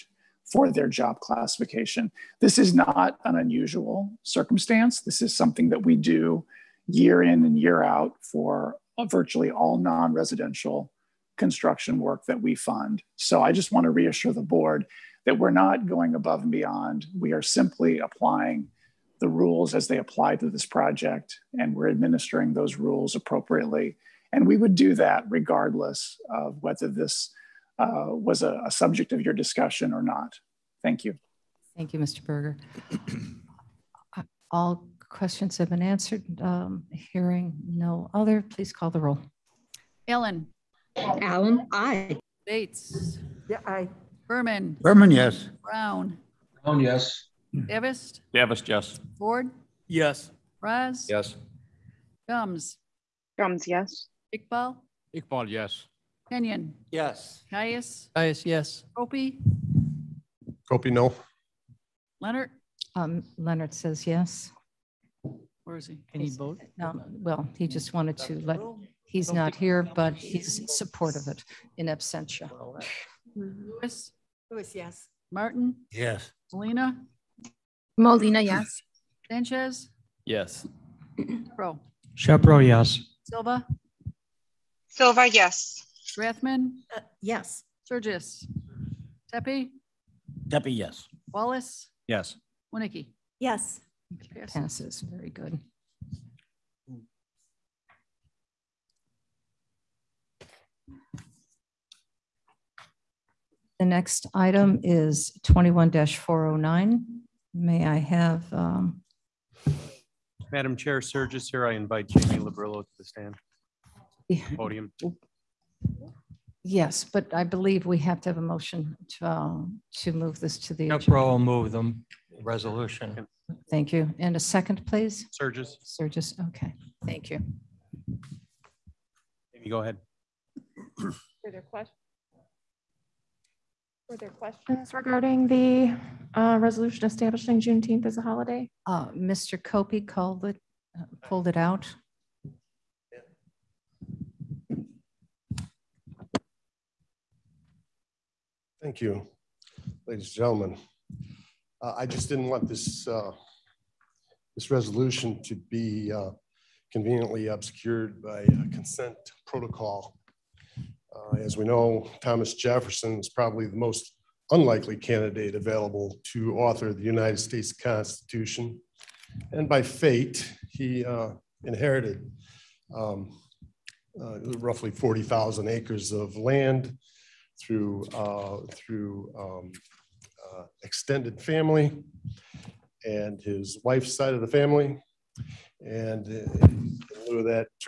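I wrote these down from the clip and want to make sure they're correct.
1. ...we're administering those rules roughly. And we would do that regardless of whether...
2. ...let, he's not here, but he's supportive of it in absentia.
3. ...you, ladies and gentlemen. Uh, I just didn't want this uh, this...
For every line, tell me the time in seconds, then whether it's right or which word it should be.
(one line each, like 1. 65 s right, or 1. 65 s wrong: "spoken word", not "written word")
1. 21 s wrong: "appropriately", not "roughly"
2. 68 s right
3. 148 s right.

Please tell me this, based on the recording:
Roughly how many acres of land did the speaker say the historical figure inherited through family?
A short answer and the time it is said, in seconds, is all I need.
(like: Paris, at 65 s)
40,000, at 174 s.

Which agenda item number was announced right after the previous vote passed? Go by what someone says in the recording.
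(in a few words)
21-409.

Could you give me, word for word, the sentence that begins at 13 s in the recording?
So I just want to reassure the board that we're not going above and beyond.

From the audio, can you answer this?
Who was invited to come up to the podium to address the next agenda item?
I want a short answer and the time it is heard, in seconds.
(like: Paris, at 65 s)
Jamie Labrillo, at 112 s.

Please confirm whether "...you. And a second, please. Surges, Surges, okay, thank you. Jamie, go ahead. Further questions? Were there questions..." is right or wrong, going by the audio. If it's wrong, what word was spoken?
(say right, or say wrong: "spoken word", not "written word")
right.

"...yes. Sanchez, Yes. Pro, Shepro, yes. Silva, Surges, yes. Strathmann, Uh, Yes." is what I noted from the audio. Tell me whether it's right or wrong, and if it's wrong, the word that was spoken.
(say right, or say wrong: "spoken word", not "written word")
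wrong: "Silva", not "Surges".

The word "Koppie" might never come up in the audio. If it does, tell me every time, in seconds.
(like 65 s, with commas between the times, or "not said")
60 s, 139 s.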